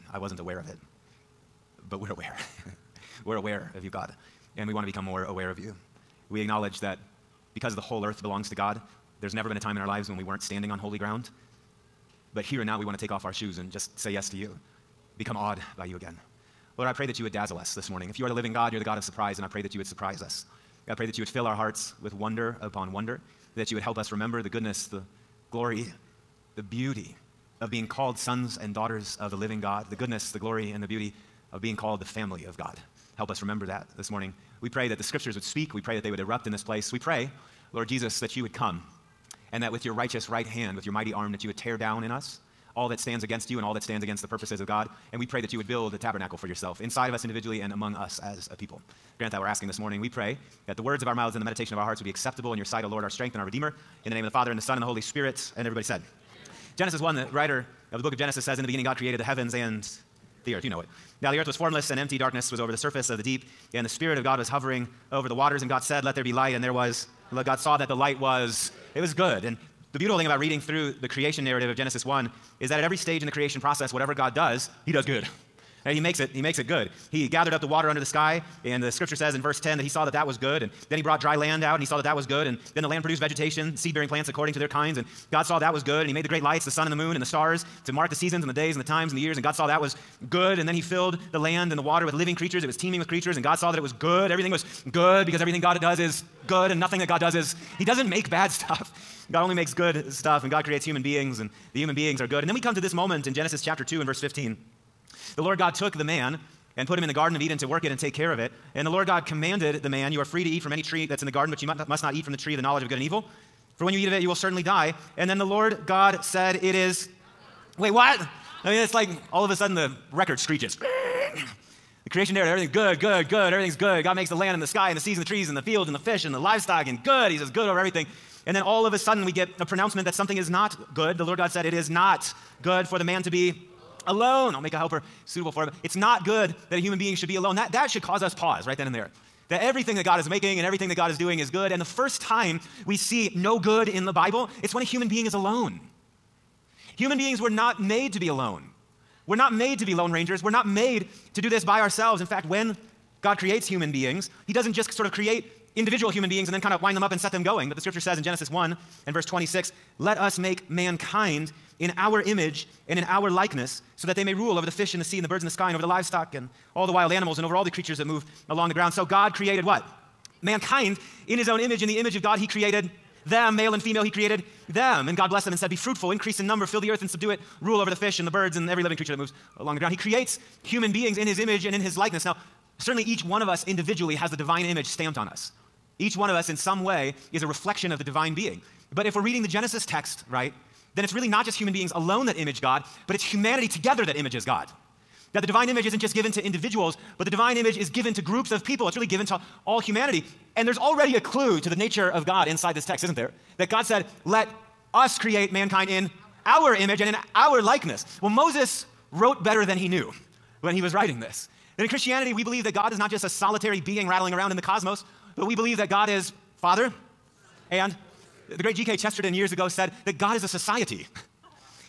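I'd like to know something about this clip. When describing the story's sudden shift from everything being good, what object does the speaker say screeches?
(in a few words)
The record.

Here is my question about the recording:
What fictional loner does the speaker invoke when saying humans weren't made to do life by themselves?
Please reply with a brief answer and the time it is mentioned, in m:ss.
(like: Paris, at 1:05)
Lone Rangers, at 2:29.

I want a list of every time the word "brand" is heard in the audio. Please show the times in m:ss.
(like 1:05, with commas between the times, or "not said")
not said.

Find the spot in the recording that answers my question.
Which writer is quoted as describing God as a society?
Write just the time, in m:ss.
3:38.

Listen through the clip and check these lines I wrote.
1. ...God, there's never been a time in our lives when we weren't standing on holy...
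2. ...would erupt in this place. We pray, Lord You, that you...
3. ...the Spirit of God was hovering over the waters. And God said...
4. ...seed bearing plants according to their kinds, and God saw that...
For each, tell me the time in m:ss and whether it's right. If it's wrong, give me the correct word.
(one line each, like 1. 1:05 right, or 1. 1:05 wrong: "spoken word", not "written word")
1. 0:08 right
2. 0:36 wrong: "Jesus", not "You"
3. 1:03 right
4. 1:23 right.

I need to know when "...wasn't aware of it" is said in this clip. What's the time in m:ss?
0:00.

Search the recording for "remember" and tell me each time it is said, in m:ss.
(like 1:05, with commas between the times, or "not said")
0:24, 0:33.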